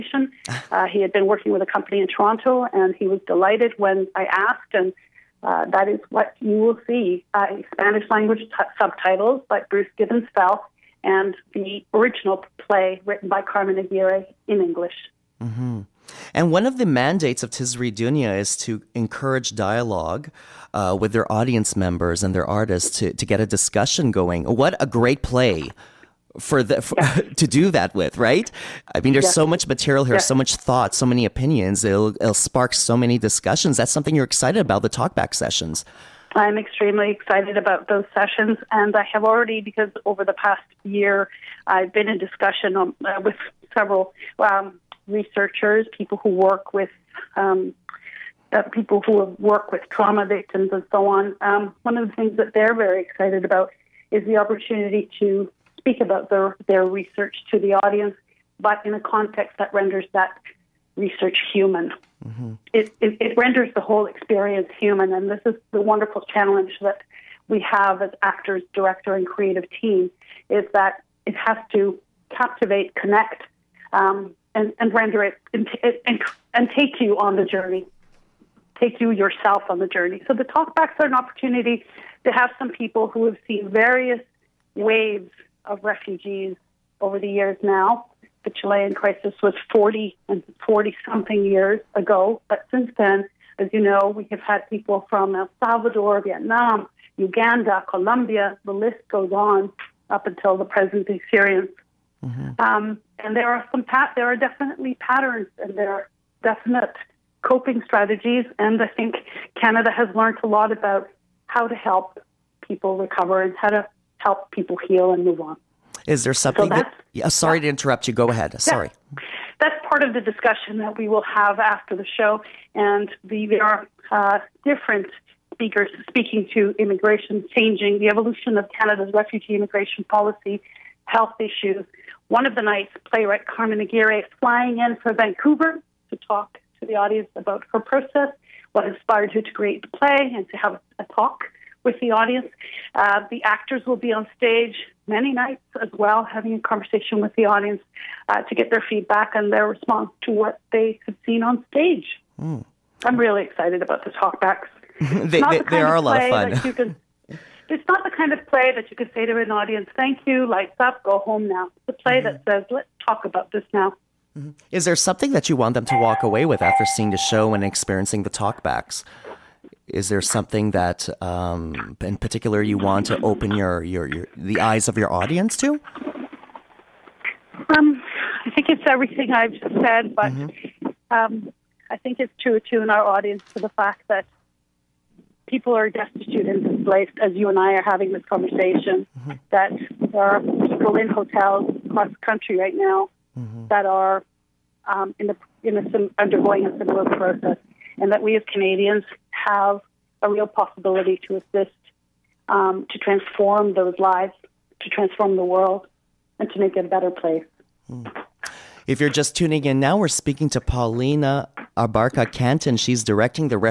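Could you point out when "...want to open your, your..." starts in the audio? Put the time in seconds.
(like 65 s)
172 s.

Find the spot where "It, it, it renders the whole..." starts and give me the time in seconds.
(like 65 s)
62 s.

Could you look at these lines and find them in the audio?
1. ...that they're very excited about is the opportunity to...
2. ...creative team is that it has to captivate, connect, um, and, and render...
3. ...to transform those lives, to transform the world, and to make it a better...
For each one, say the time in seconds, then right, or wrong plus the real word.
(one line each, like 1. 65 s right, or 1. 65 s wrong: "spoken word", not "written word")
1. 52 s right
2. 69 s right
3. 202 s right.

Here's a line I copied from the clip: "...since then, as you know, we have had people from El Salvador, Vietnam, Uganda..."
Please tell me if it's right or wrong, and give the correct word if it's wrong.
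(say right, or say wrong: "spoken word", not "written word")
right.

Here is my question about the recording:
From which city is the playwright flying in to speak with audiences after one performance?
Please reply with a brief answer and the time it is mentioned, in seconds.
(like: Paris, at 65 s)
Vancouver, at 135 s.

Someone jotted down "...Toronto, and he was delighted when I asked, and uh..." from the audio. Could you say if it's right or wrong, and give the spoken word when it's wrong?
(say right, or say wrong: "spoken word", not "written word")
right.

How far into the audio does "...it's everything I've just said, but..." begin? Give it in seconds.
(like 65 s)
178 s.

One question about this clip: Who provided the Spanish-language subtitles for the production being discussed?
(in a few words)
Bruce Gibbons.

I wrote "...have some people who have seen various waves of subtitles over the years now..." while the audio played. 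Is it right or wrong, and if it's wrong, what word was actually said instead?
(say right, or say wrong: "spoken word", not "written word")
wrong: "refugees", not "subtitles".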